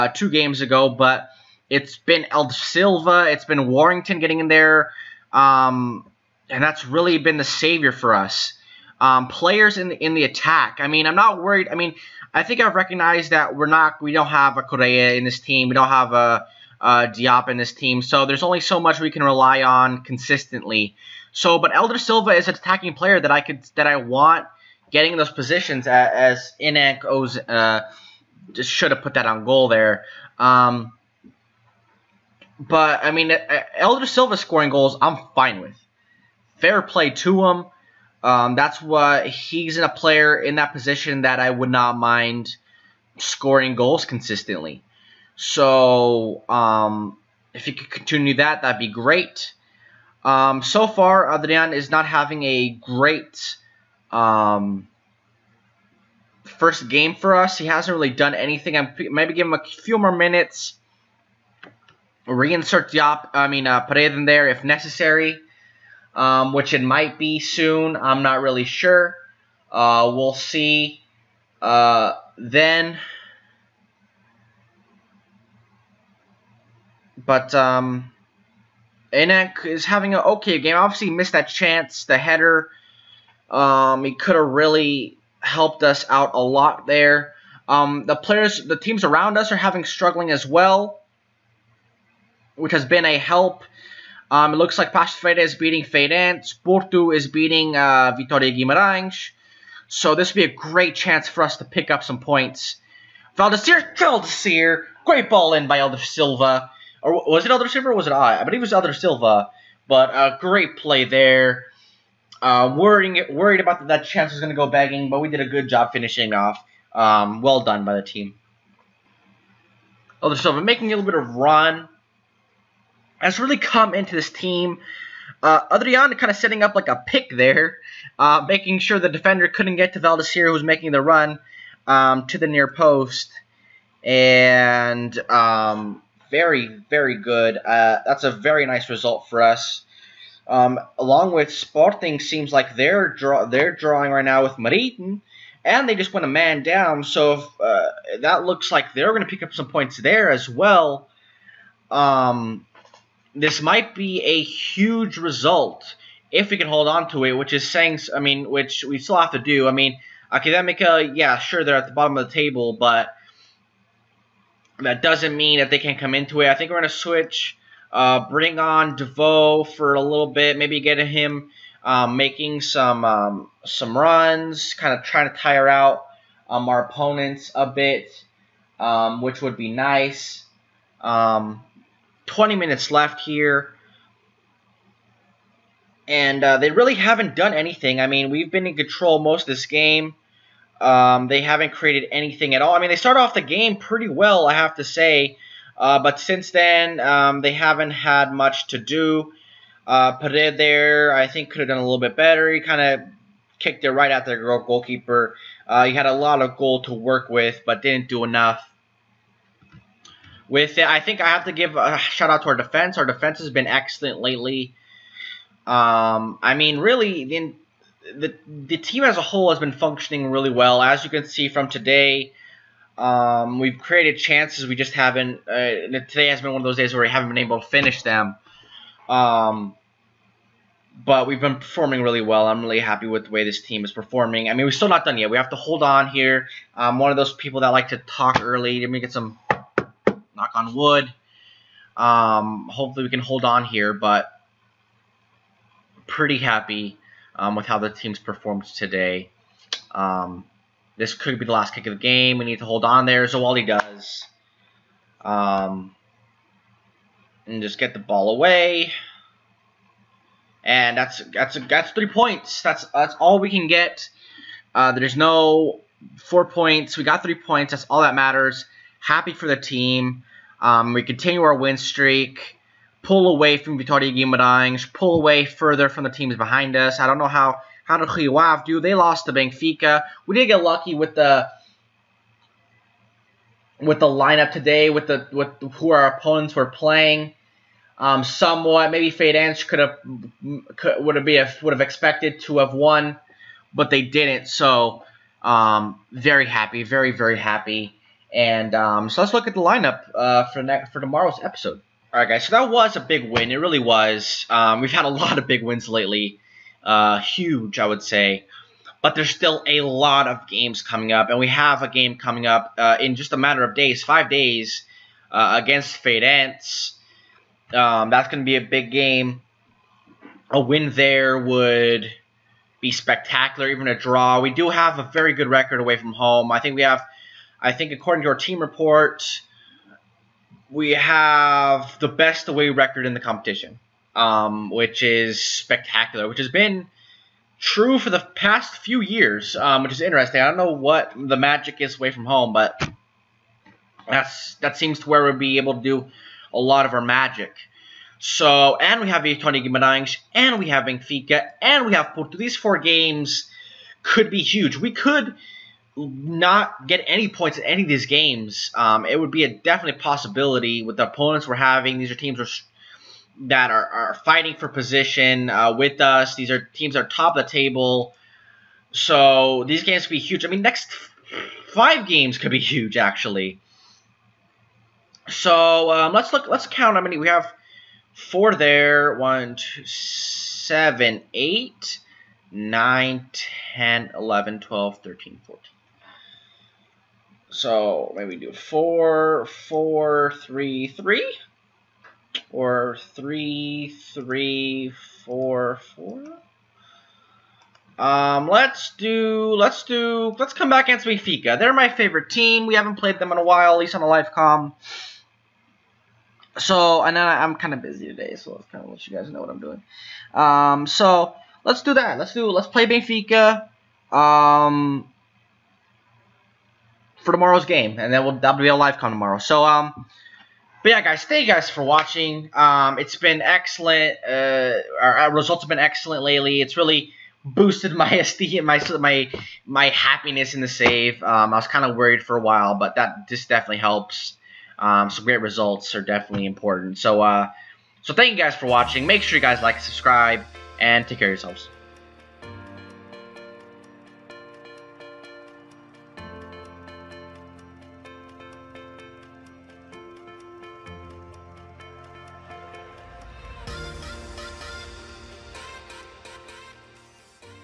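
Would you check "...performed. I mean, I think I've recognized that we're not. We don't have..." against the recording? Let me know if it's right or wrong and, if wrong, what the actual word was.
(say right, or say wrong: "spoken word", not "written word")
wrong: "worried", not "performed".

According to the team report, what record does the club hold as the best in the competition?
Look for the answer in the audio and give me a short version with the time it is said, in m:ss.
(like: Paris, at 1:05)
Away record, at 5:32.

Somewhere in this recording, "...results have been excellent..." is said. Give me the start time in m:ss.
7:05.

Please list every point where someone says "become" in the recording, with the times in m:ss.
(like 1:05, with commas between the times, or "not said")
not said.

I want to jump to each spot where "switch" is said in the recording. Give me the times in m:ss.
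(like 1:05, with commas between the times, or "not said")
2:46.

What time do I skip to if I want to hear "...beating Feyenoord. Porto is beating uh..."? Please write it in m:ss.
1:35.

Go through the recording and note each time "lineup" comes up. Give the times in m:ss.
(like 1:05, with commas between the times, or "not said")
4:44, 4:59.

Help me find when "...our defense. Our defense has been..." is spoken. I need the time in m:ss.
3:32.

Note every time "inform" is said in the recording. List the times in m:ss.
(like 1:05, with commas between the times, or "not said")
not said.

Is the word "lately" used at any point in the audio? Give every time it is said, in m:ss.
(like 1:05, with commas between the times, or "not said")
3:34, 5:05, 7:06.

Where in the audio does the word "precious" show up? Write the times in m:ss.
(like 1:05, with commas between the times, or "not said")
not said.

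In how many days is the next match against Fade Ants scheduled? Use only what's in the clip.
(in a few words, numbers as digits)
5.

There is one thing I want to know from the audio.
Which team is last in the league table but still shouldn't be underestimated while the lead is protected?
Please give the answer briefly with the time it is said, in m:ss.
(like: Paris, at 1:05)
Academica, at 2:40.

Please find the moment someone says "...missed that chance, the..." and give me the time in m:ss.
1:21.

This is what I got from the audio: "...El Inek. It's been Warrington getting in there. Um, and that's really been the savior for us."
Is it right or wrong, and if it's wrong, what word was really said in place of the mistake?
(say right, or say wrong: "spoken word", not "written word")
wrong: "Silva", not "Inek".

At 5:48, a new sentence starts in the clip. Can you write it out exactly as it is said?
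So, and we have Tony Guimarães, and we have Benfica, and we have Porto.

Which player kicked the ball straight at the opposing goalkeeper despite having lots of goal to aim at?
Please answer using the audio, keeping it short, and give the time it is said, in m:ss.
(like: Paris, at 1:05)
Pared, at 3:20.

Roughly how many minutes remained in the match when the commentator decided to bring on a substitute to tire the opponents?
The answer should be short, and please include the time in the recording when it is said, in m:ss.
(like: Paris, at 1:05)
20, at 3:02.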